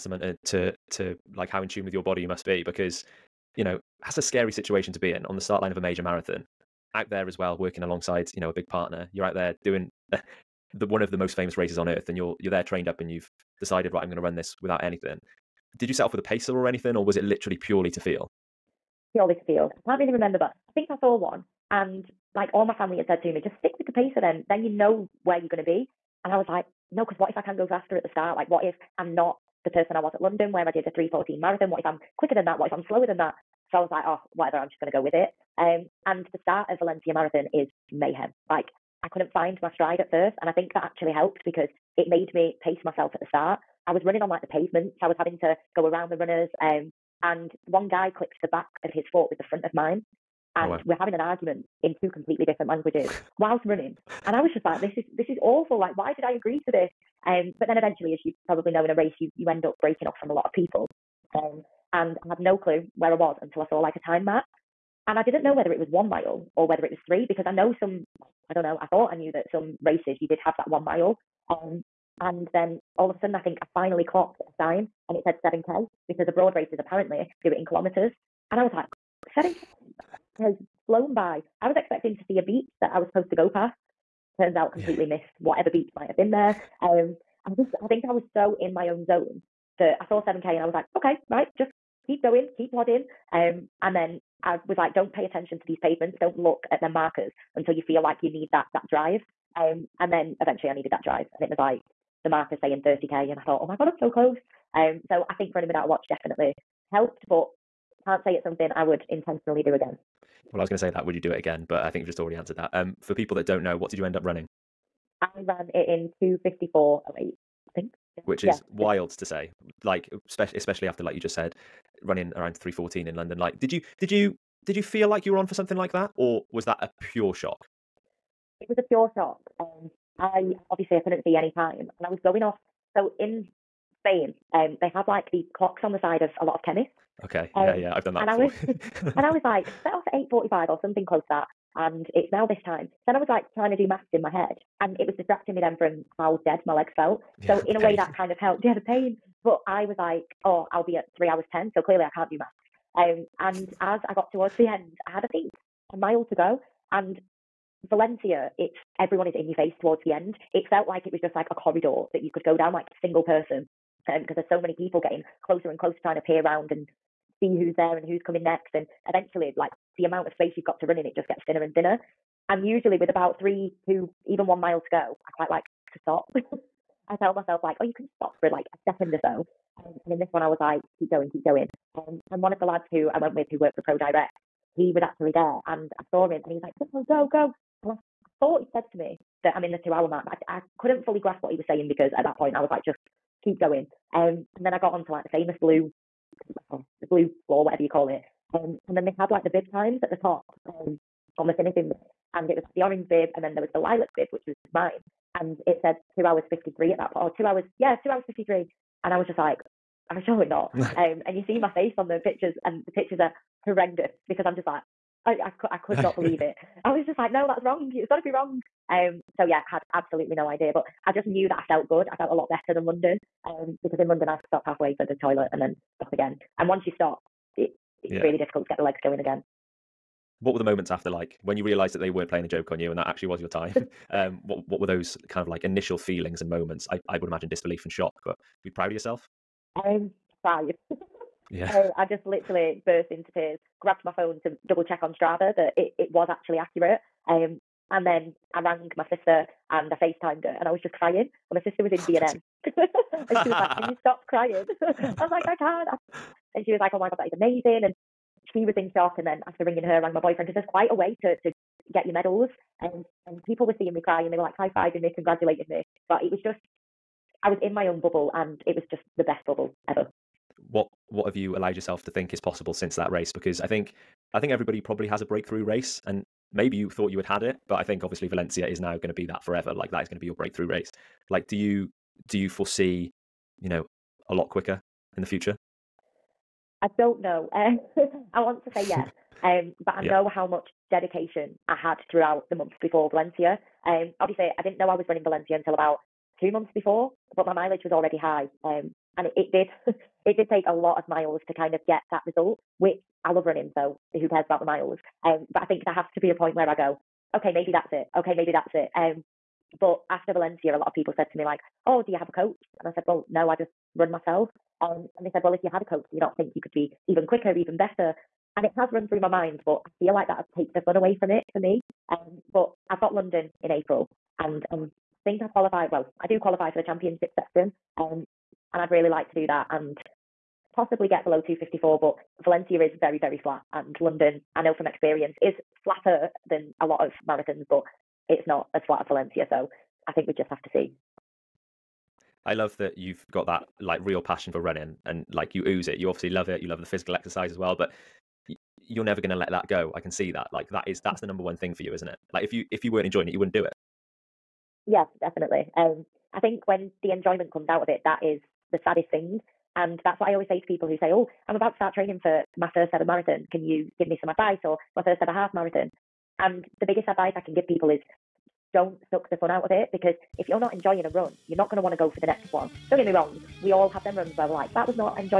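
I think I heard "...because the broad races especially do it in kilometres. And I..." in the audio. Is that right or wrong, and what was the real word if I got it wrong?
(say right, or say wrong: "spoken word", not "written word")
wrong: "apparently", not "especially".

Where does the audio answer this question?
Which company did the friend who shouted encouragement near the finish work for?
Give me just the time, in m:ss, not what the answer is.
3:03.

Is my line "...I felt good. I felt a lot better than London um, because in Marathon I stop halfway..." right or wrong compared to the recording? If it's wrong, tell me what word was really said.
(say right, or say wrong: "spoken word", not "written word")
wrong: "London", not "Marathon".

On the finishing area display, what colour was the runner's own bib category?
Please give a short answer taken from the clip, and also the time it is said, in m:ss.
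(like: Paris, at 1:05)
Lilac, at 3:23.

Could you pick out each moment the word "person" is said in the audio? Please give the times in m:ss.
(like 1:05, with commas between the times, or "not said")
0:29, 2:43.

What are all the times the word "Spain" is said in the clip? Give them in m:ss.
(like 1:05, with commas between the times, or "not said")
2:14.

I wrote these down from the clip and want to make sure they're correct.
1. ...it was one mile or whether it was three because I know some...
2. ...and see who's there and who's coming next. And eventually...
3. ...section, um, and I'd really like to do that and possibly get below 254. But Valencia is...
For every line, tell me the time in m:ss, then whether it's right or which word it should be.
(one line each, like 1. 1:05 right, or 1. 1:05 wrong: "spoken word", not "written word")
1. 1:05 right
2. 2:46 right
3. 5:27 right.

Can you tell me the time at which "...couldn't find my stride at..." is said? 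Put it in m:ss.
0:39.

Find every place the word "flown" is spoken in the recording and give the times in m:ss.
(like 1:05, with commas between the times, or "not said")
1:20.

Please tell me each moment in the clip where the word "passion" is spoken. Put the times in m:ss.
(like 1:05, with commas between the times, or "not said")
5:44.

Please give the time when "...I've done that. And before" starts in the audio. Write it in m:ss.
2:17.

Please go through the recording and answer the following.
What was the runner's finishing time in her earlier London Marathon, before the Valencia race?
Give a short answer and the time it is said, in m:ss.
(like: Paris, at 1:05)
3:14, at 0:30.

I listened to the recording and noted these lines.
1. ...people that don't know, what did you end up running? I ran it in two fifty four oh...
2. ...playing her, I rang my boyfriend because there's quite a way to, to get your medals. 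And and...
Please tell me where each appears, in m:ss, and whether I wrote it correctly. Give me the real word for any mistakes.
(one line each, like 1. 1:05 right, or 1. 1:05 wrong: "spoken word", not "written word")
1. 1:53 right
2. 4:19 wrong: "ringing", not "playing".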